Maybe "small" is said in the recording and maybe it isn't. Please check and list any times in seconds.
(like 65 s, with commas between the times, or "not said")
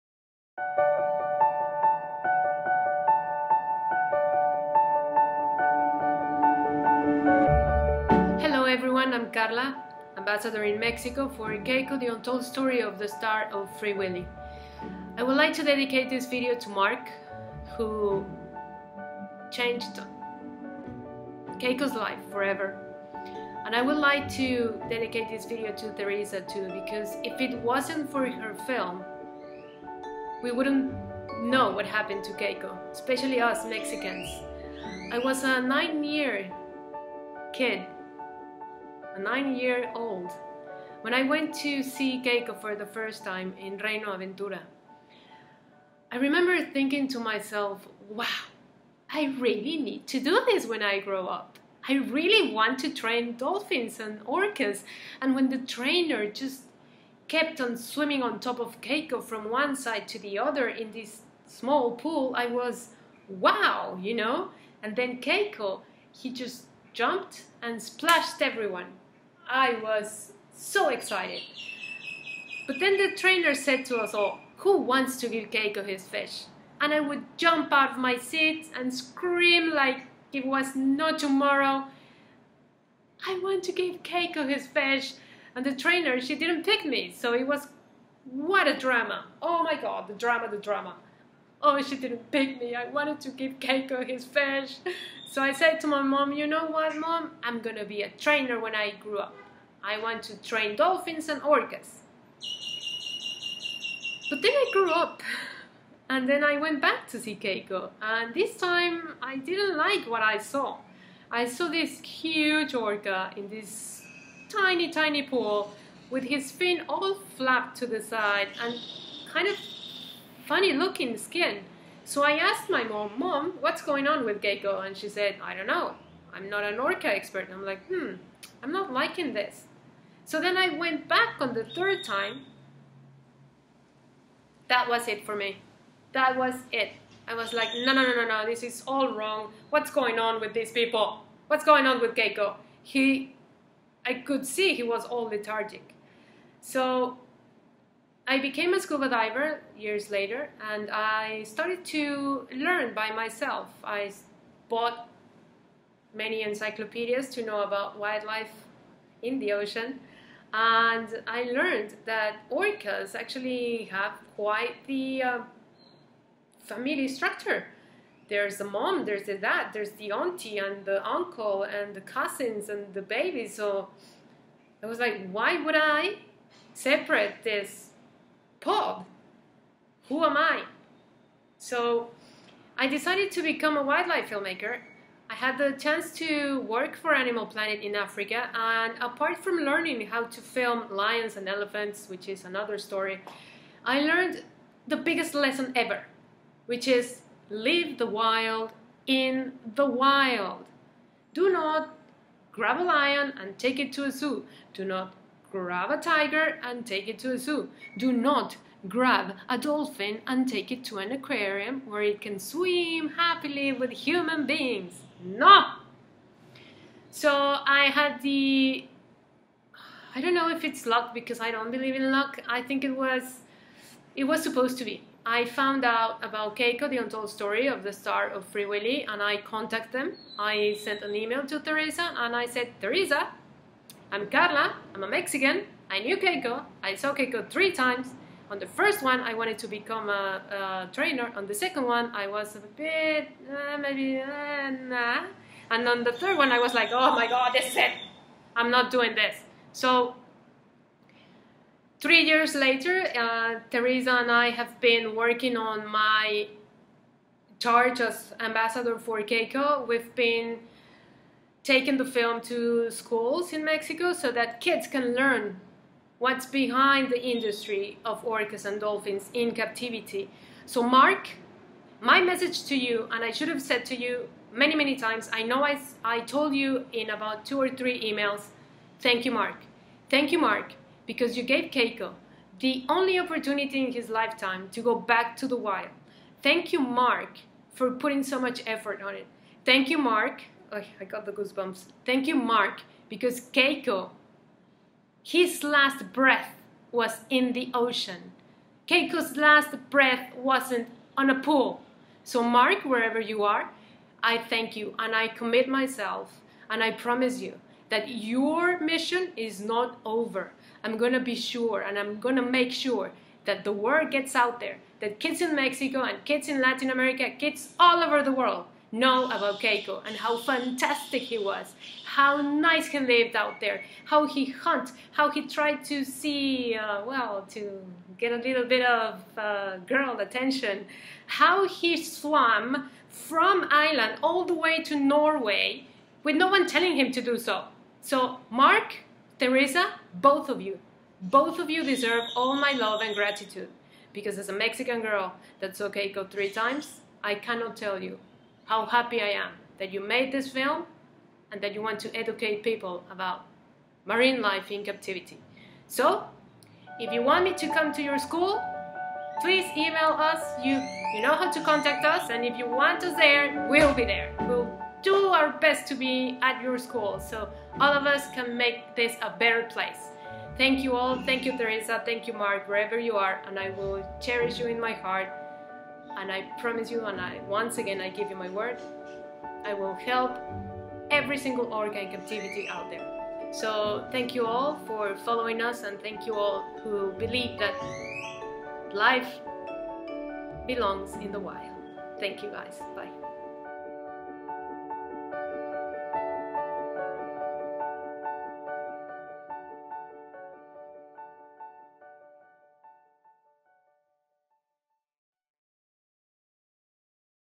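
61 s.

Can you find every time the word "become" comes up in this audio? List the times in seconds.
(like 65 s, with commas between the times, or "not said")
183 s, 239 s.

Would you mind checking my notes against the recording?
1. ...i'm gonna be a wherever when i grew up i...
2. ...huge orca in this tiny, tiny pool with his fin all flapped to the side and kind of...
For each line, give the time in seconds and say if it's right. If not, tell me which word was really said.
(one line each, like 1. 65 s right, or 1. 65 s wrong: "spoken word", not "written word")
1. 97 s wrong: "trainer", not "wherever"
2. 112 s right.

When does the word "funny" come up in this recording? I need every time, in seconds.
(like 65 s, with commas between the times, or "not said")
120 s.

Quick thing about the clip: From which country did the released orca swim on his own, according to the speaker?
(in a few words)
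Ireland.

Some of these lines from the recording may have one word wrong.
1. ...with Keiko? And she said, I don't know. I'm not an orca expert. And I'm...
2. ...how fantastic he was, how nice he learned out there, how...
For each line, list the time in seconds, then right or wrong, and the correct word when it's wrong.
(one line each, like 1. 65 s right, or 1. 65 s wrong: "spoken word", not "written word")
1. 124 s right
2. 320 s wrong: "lived", not "learned".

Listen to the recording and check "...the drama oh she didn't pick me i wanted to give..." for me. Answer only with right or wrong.
right.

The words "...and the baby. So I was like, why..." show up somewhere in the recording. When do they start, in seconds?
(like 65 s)
172 s.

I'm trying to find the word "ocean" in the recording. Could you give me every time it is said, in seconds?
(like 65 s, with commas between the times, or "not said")
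159 s, 297 s.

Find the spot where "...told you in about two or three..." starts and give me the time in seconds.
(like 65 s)
276 s.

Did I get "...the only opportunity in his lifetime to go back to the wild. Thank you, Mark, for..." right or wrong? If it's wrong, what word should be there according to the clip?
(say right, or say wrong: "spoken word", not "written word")
right.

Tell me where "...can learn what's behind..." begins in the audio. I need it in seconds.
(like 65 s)
264 s.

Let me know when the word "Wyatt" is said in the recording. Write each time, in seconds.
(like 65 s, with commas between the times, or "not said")
not said.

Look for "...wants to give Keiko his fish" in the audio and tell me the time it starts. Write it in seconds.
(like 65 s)
74 s.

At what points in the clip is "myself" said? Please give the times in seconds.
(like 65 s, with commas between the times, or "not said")
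47 s, 153 s, 305 s.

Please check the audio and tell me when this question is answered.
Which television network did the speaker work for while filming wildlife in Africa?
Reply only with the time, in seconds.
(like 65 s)
187 s.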